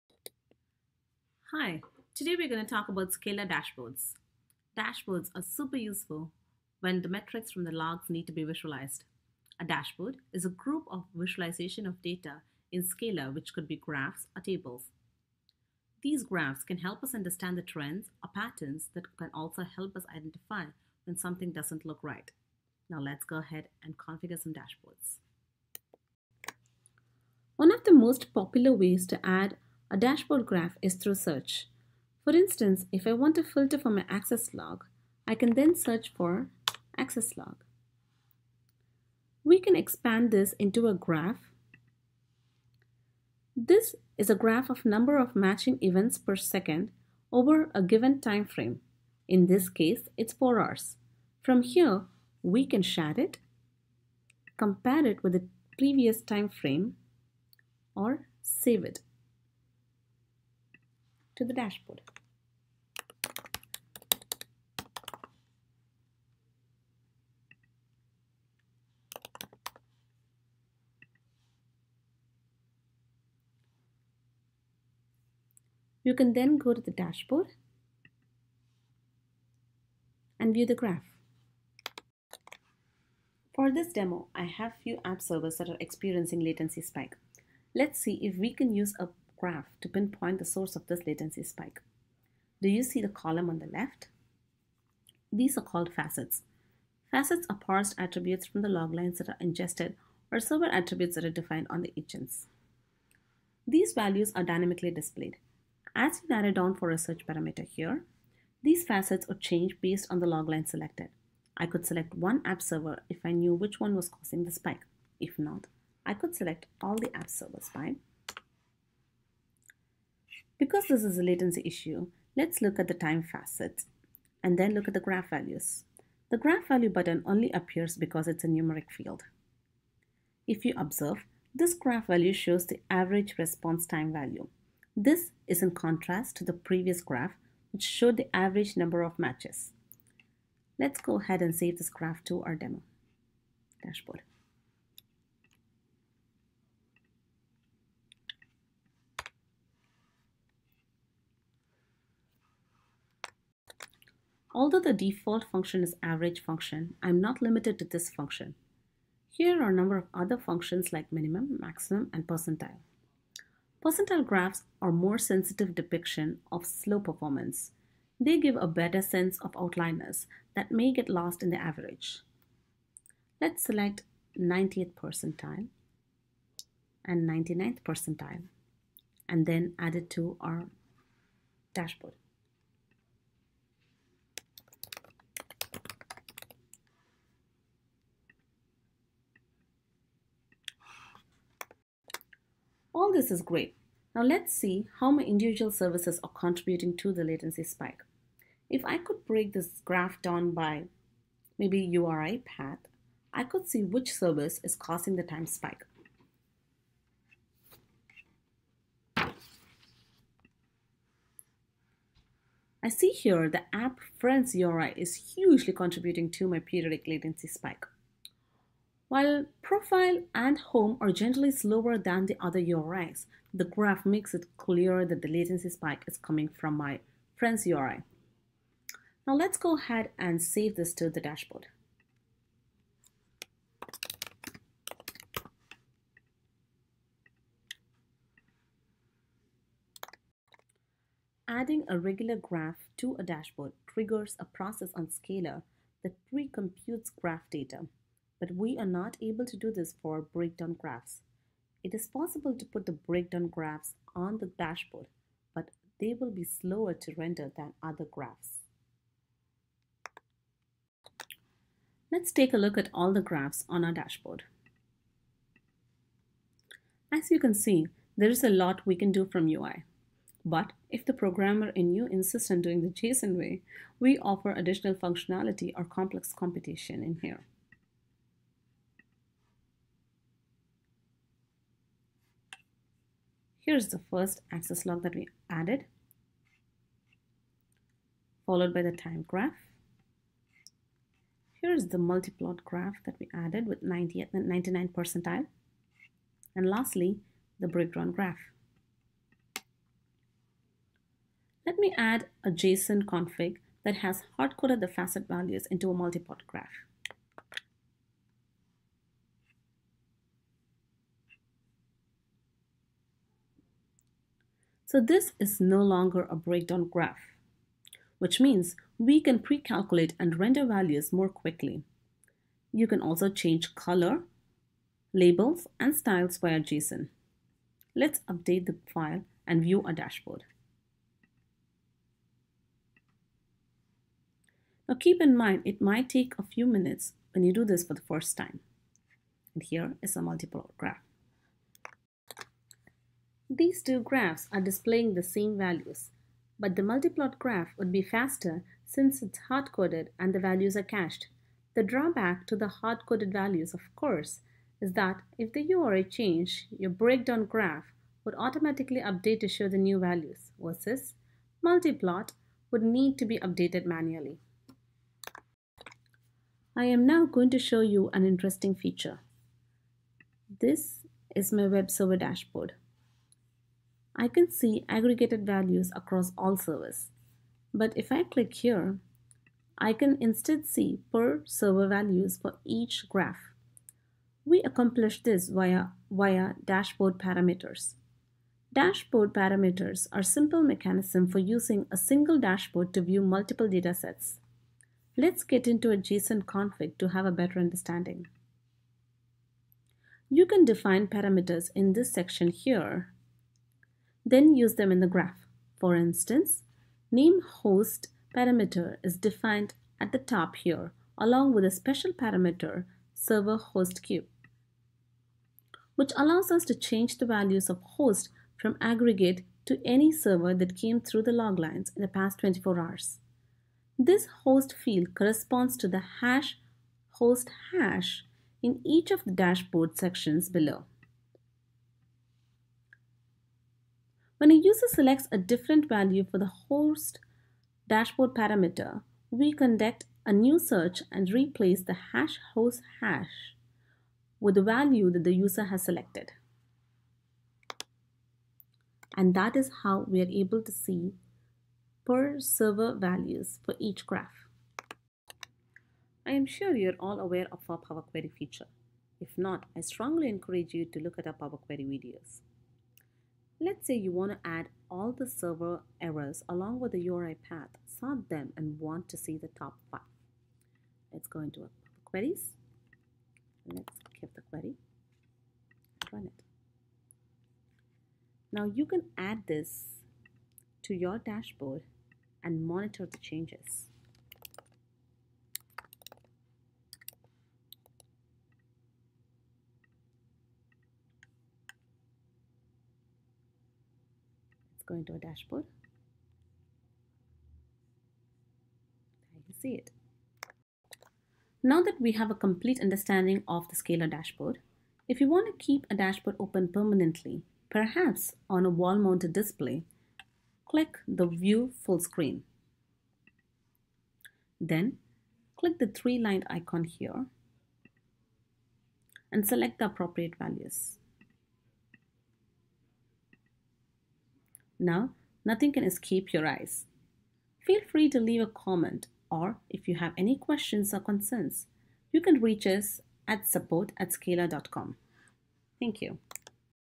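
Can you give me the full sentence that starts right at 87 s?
Let's see if we can use a graph to pinpoint the source of this latency spike.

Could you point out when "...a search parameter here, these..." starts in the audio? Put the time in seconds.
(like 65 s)
106 s.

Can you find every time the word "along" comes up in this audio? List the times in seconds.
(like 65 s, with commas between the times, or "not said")
411 s, 466 s.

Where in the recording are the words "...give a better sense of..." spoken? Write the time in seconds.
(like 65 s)
168 s.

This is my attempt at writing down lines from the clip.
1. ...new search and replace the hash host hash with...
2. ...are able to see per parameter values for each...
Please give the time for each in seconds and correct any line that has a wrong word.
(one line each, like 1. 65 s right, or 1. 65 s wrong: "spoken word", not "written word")
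1. 440 s right
2. 450 s wrong: "server", not "parameter".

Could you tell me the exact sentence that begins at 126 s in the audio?
The graph value button only appears because it's a numeric field.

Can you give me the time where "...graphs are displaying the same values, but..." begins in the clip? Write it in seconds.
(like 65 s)
343 s.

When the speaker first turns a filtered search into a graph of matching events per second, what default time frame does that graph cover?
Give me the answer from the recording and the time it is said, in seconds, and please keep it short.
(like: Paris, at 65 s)
4 hours, at 50 s.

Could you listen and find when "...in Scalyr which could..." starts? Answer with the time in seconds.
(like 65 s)
12 s.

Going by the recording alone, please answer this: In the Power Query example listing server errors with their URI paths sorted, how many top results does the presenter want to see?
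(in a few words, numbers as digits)
5.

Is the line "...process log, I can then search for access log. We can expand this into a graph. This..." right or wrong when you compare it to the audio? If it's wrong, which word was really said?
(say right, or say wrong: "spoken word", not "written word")
wrong: "access", not "process".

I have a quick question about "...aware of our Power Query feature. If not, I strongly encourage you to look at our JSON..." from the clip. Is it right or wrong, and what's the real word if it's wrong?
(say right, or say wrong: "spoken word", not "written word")
wrong: "Power", not "JSON".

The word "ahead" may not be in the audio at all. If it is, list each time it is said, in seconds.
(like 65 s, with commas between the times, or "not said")
23 s, 141 s, 229 s.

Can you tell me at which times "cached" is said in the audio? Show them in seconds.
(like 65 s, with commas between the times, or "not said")
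350 s.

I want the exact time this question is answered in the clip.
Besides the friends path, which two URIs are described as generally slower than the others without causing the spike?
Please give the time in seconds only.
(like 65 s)
219 s.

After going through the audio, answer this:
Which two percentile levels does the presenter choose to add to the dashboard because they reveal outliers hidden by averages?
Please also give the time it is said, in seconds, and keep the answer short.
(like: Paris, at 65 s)
90th and 99th, at 174 s.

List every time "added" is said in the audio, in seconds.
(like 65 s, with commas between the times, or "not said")
285 s, 293 s.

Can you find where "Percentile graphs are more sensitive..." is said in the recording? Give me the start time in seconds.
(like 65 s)
163 s.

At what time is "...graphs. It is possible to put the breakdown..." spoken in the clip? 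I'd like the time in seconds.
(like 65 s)
250 s.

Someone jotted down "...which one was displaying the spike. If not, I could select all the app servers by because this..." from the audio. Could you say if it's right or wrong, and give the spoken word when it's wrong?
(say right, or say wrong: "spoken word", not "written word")
wrong: "causing", not "displaying".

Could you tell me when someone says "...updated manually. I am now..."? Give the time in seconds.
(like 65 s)
363 s.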